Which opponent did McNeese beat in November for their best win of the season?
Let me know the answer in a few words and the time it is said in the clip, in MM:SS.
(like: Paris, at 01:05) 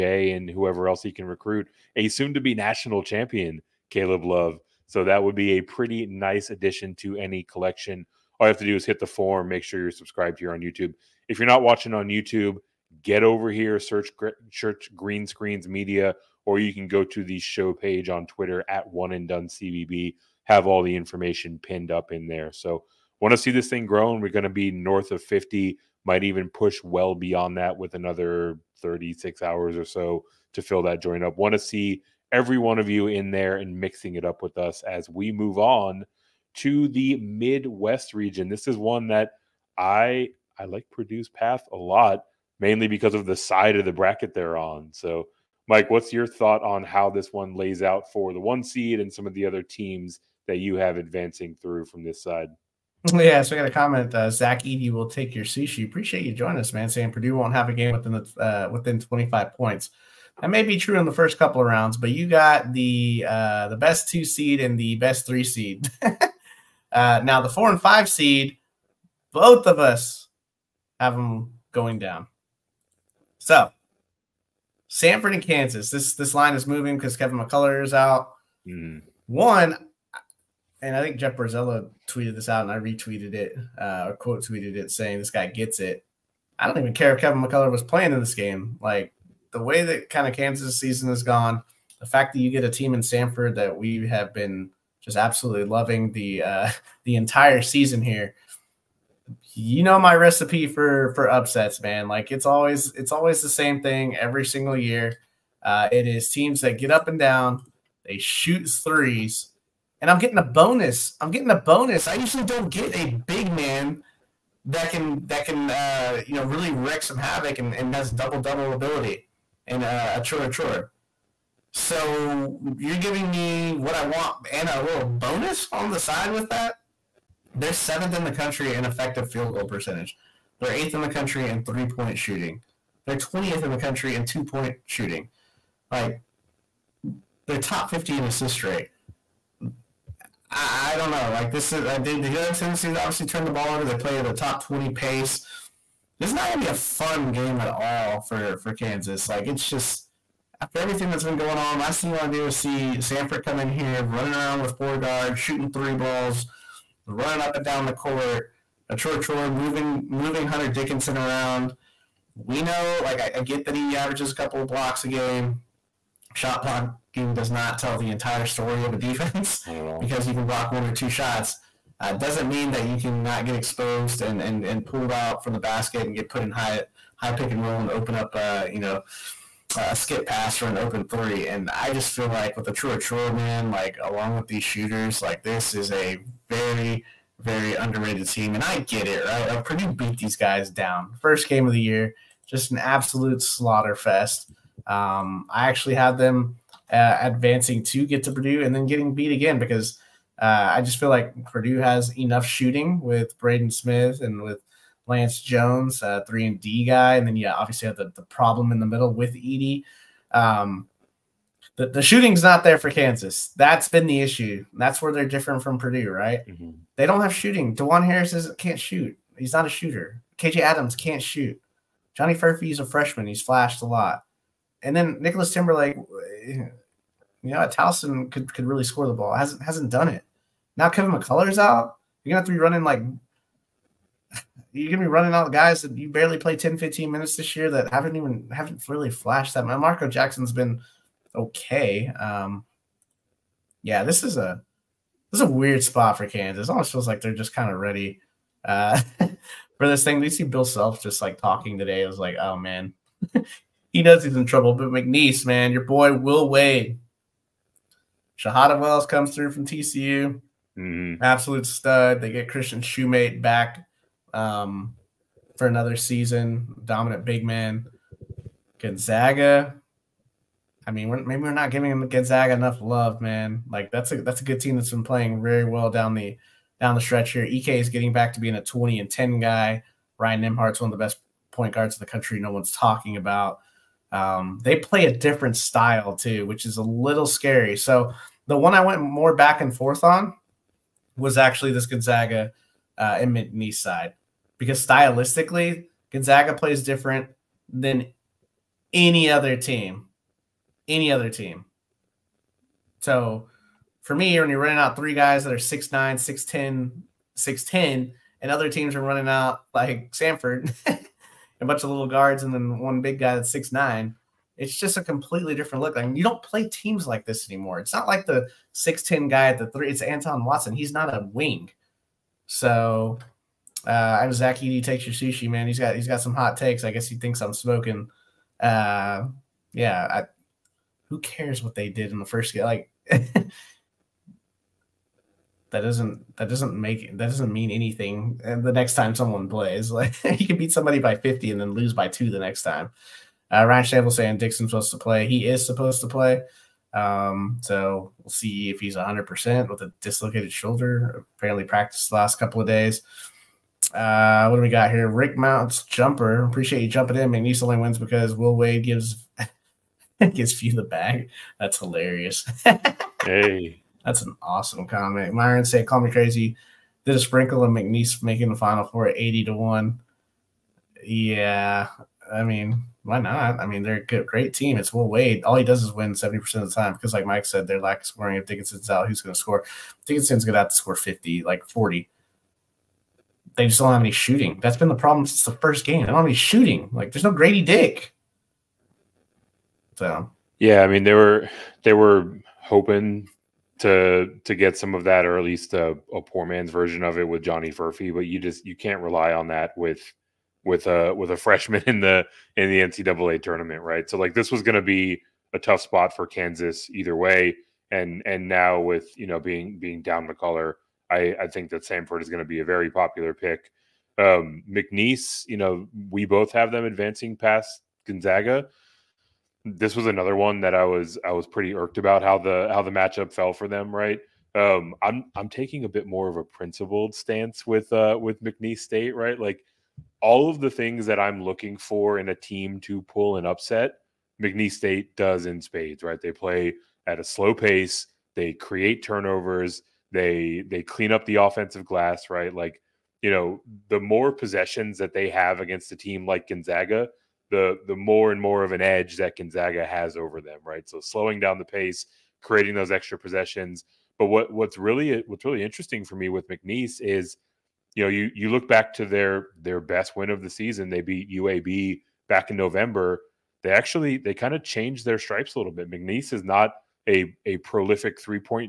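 UAB, at 07:41.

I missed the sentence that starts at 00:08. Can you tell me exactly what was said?
All you have to do is hit the form, make sure you're subscribed here on YouTube.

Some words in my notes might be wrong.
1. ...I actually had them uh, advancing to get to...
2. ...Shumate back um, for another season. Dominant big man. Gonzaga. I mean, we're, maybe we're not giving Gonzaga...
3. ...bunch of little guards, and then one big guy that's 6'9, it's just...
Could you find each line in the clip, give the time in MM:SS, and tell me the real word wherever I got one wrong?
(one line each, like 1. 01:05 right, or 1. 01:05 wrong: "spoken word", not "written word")
1. 03:15 right
2. 04:22 right
3. 05:11 right.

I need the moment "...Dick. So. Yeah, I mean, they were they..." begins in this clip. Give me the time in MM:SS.
06:27.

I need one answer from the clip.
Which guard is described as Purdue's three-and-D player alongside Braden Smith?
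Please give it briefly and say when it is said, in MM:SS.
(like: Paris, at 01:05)
Lance Jones, at 03:25.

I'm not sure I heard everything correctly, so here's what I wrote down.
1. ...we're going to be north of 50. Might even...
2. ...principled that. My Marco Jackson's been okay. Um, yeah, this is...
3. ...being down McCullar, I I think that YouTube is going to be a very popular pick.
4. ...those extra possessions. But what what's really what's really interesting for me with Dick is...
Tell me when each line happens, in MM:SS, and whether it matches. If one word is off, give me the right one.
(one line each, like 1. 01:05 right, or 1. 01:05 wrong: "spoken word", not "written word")
1. 00:24 right
2. 03:59 wrong: "flashed", not "principled"
3. 06:49 wrong: "Samford", not "YouTube"
4. 07:32 wrong: "McNeese", not "Dick".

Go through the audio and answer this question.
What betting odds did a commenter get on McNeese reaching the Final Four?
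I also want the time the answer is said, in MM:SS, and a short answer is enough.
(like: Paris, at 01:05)
80 to 1, at 06:09.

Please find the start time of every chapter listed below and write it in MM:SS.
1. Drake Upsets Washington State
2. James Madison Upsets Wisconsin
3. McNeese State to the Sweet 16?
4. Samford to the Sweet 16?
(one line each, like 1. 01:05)
1. 00:18
2. 01:41
3. 03:22
4. 05:31.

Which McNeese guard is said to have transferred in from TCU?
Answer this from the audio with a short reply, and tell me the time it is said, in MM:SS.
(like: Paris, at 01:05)
Shahada Wells, at 04:18.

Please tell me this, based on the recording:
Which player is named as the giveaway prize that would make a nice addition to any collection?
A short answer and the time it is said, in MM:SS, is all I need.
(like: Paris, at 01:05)
Caleb Love, at 00:03.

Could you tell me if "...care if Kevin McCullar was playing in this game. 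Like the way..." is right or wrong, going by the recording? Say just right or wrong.
right.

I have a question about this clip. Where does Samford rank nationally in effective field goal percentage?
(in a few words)
7th.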